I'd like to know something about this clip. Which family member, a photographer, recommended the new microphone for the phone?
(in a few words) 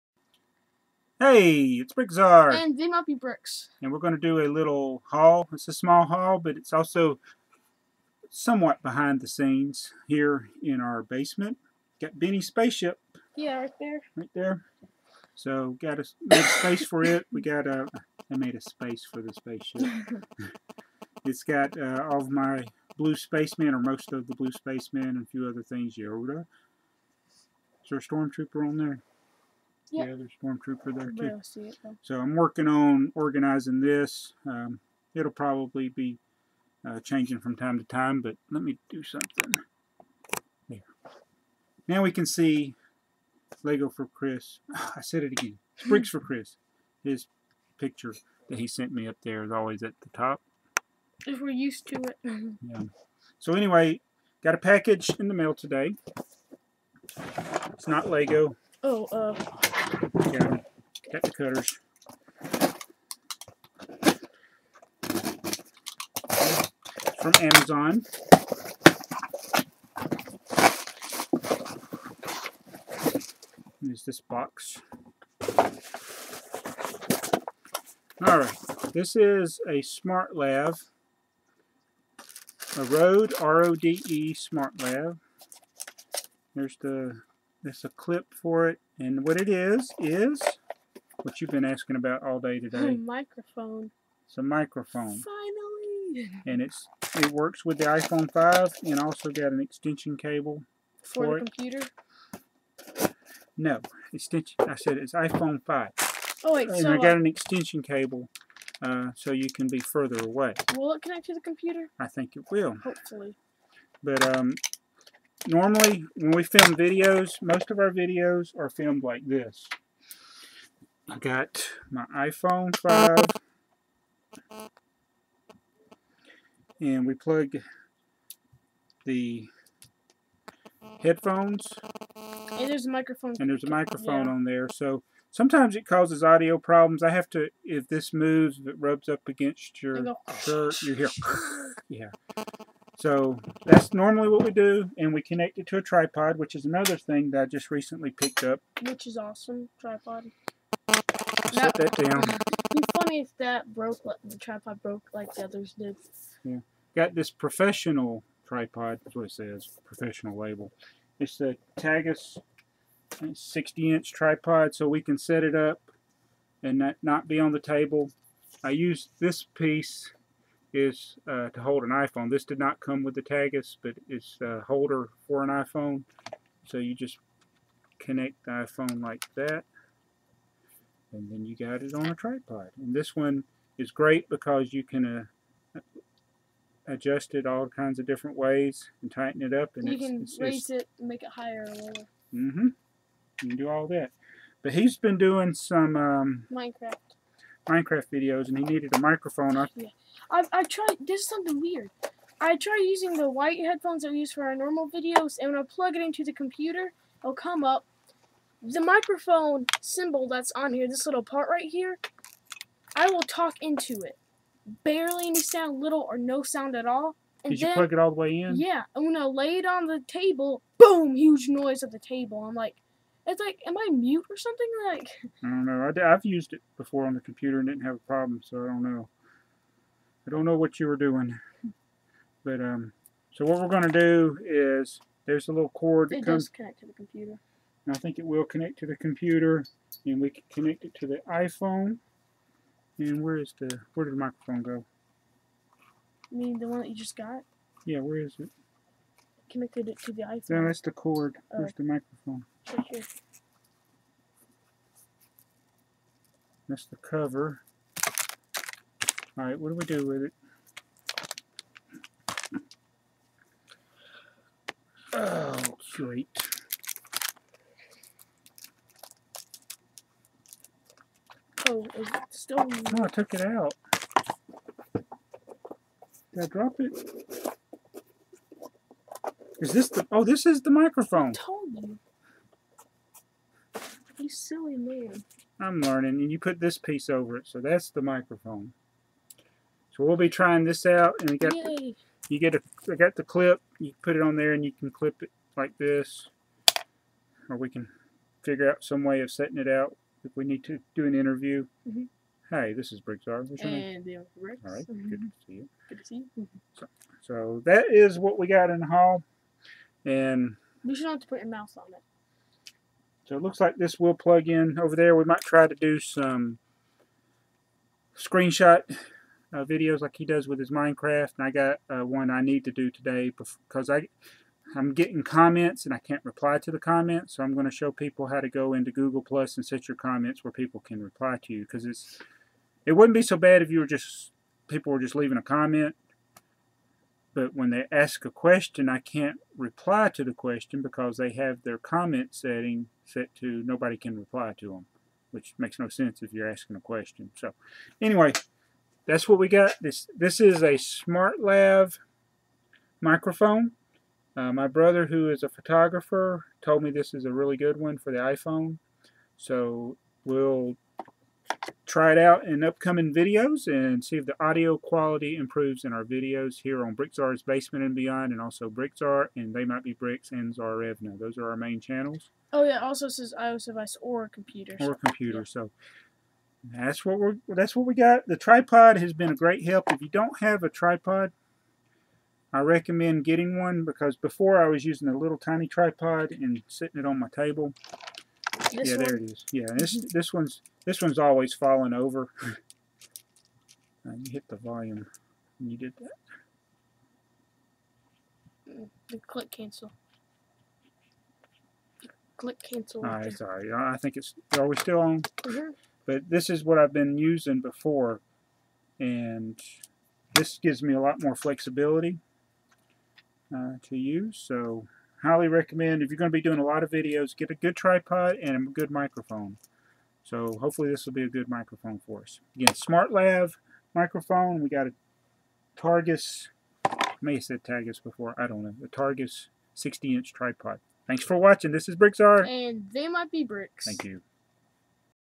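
brother.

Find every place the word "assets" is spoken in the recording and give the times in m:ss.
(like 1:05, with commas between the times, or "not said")
not said.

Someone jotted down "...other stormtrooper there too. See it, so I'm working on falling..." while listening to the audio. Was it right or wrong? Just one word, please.
wrong.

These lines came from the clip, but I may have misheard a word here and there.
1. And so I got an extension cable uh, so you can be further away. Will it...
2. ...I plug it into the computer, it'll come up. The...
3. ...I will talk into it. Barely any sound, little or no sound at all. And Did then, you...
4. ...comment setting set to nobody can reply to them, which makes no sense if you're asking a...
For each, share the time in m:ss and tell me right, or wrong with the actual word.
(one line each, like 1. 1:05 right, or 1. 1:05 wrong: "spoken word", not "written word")
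1. 1:46 right
2. 3:25 right
3. 3:32 right
4. 5:41 right.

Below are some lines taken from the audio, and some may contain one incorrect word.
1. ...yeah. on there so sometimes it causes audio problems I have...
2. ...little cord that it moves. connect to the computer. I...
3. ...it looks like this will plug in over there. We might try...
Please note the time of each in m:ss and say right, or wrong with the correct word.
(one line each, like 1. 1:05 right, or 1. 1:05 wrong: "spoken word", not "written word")
1. 2:14 right
2. 3:55 wrong: "comes", not "moves"
3. 5:13 right.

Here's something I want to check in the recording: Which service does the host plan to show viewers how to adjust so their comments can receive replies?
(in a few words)
Google Plus.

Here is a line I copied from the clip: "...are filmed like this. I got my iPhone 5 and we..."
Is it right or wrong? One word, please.
right.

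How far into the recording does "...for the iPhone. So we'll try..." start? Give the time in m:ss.
5:57.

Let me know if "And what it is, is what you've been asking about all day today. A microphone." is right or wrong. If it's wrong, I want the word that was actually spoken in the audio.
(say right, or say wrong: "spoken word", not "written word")
right.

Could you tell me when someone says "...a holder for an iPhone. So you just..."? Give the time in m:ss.
2:54.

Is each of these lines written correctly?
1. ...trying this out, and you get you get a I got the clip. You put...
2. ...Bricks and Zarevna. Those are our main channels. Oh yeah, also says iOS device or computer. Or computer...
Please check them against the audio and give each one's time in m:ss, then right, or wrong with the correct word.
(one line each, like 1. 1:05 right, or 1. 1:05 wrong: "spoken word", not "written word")
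1. 4:50 right
2. 6:09 right.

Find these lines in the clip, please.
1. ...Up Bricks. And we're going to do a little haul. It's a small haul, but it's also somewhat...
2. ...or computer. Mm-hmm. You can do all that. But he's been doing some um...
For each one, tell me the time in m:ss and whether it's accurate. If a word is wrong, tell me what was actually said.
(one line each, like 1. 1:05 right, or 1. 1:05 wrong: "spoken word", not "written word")
1. 0:02 right
2. 3:11 wrong: "lower", not "computer".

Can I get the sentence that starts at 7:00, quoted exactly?
So hopefully this will be a good microphone for us.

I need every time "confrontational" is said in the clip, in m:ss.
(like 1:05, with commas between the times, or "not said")
not said.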